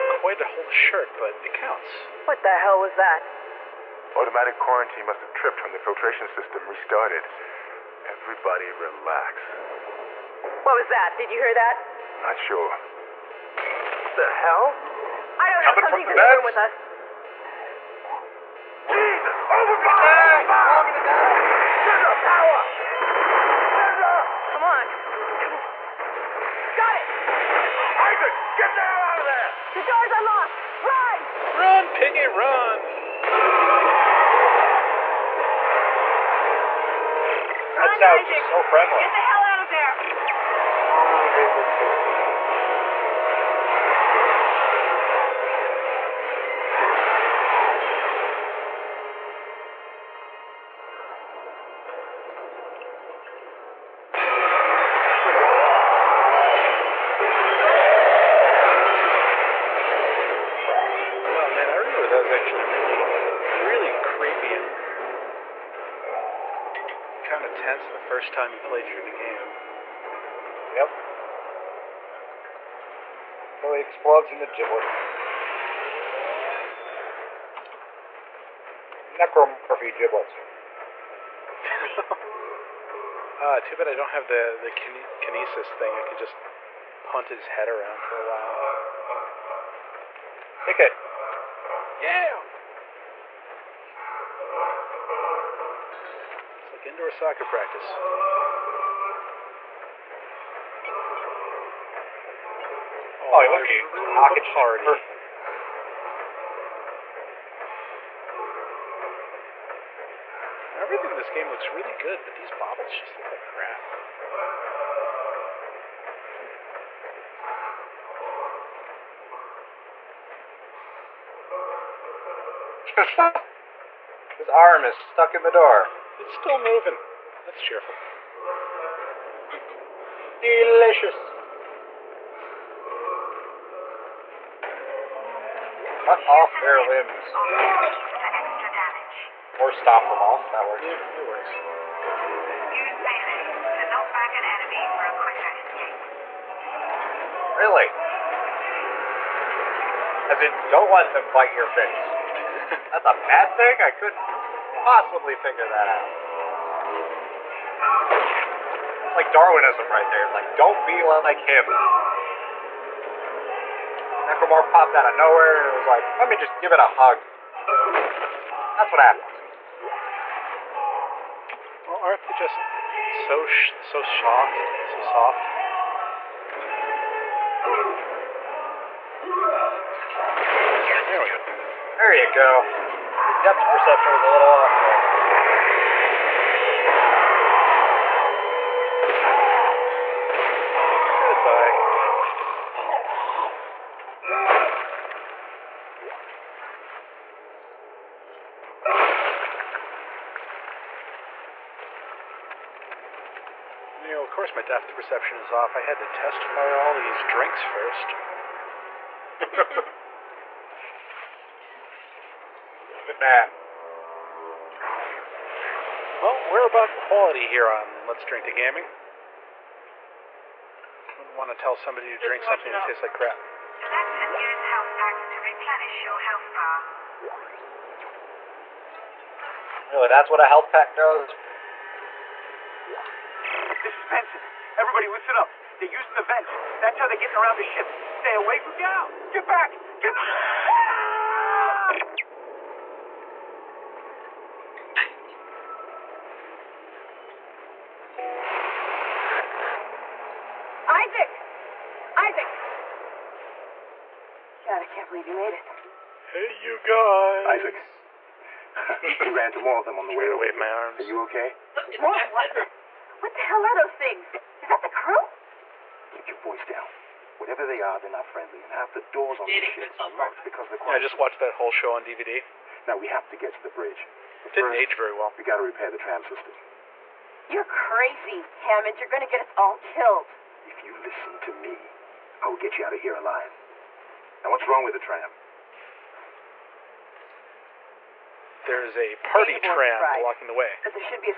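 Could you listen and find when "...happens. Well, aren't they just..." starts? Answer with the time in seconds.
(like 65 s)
169 s.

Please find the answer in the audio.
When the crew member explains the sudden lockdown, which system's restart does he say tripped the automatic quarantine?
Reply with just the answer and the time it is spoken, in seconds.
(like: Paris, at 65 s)
Filtration system, at 5 s.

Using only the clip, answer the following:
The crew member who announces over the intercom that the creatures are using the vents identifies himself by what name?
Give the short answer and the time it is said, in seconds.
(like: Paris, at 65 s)
Benson, at 234 s.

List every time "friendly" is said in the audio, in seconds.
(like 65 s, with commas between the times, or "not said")
38 s, 268 s.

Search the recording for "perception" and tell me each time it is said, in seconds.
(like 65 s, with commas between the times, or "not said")
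183 s, 204 s.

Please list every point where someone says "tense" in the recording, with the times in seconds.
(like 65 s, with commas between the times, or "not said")
67 s.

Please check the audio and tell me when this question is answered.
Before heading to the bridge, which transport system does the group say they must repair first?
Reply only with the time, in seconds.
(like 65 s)
275 s.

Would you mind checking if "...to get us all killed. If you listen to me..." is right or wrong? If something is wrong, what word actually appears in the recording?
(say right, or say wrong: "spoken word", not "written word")
right.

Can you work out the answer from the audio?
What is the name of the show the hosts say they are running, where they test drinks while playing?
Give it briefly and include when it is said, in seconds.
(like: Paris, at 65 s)
Let's Drink to Gaming, at 218 s.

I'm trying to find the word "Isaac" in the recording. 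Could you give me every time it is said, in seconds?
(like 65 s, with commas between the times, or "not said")
28 s, 258 s.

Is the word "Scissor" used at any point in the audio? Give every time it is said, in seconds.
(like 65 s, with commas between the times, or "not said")
21 s.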